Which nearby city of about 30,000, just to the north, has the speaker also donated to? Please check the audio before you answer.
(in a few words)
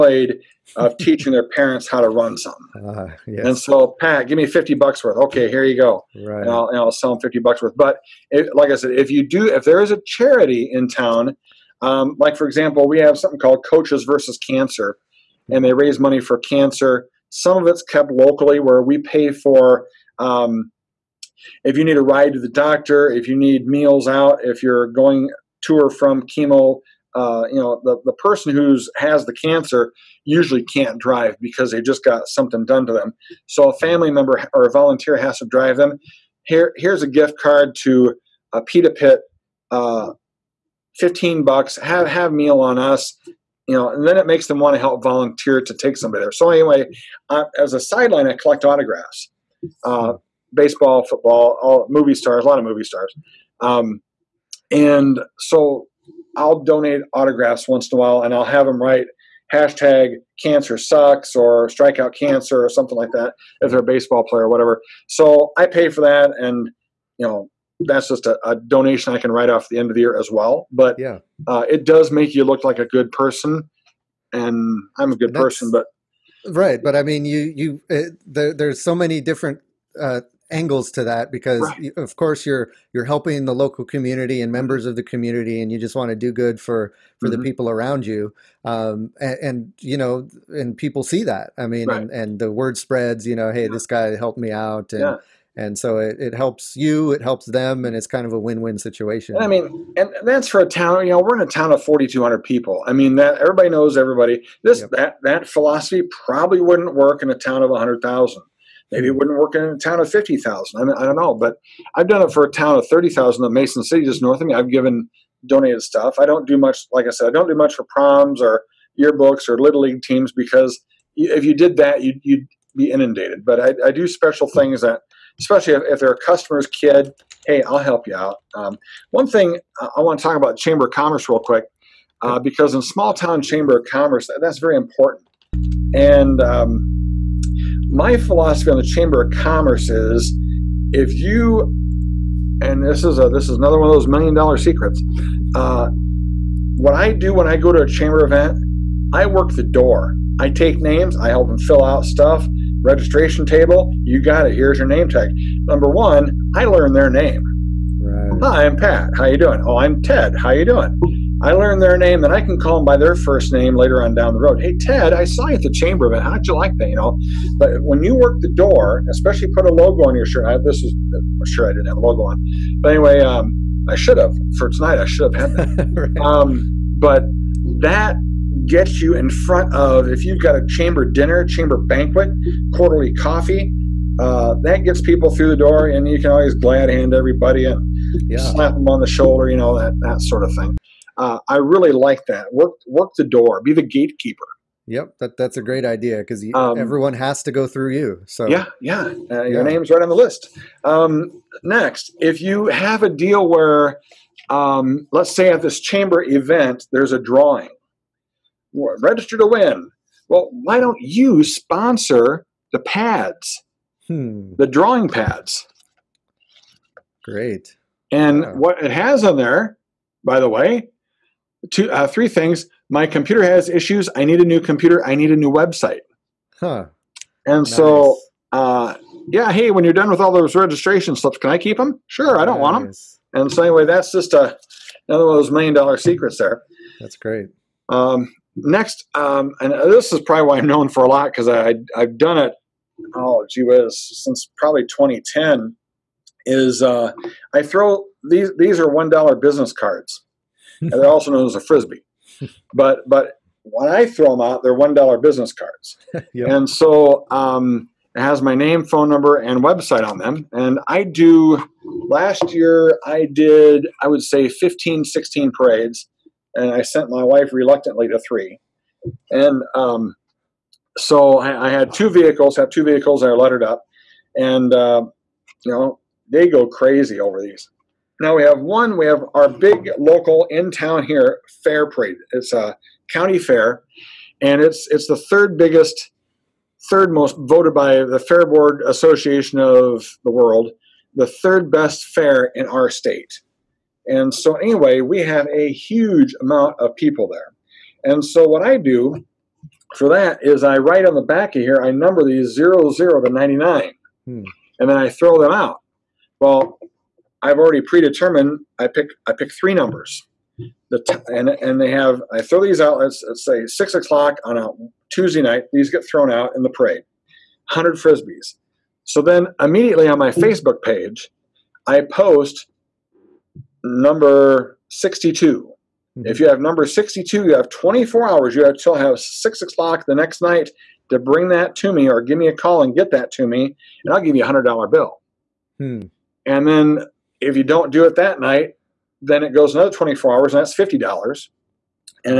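Mason City.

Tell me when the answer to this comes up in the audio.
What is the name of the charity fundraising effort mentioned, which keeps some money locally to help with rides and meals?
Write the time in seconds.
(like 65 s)
13 s.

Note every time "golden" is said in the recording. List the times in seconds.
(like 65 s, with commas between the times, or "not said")
not said.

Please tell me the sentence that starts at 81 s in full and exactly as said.
of course you're you're helping the local community and mm-hmm.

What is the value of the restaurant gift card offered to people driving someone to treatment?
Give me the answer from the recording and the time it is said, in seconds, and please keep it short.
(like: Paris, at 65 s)
$15, at 40 s.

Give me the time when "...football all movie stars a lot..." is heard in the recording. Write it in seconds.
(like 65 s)
51 s.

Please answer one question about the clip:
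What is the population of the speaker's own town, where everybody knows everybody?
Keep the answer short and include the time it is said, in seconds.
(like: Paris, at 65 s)
4200, at 101 s.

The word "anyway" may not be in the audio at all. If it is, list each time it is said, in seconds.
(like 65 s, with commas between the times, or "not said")
46 s, 172 s, 233 s, 294 s.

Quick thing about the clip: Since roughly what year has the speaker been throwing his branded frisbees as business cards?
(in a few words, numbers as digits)
2010.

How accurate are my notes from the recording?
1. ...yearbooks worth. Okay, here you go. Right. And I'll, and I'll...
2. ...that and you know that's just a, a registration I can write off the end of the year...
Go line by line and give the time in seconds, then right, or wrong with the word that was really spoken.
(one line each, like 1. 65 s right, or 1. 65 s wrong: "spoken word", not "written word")
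1. 4 s wrong: "bucks", not "yearbooks"
2. 66 s wrong: "donation", not "registration".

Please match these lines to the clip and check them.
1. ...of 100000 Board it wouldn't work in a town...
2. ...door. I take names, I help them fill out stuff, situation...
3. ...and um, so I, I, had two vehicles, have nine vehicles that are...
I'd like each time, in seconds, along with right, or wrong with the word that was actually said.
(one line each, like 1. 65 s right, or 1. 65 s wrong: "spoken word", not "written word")
1. 107 s wrong: "Maybe", not "Board"
2. 149 s wrong: "registration", not "situation"
3. 269 s wrong: "two", not "nine".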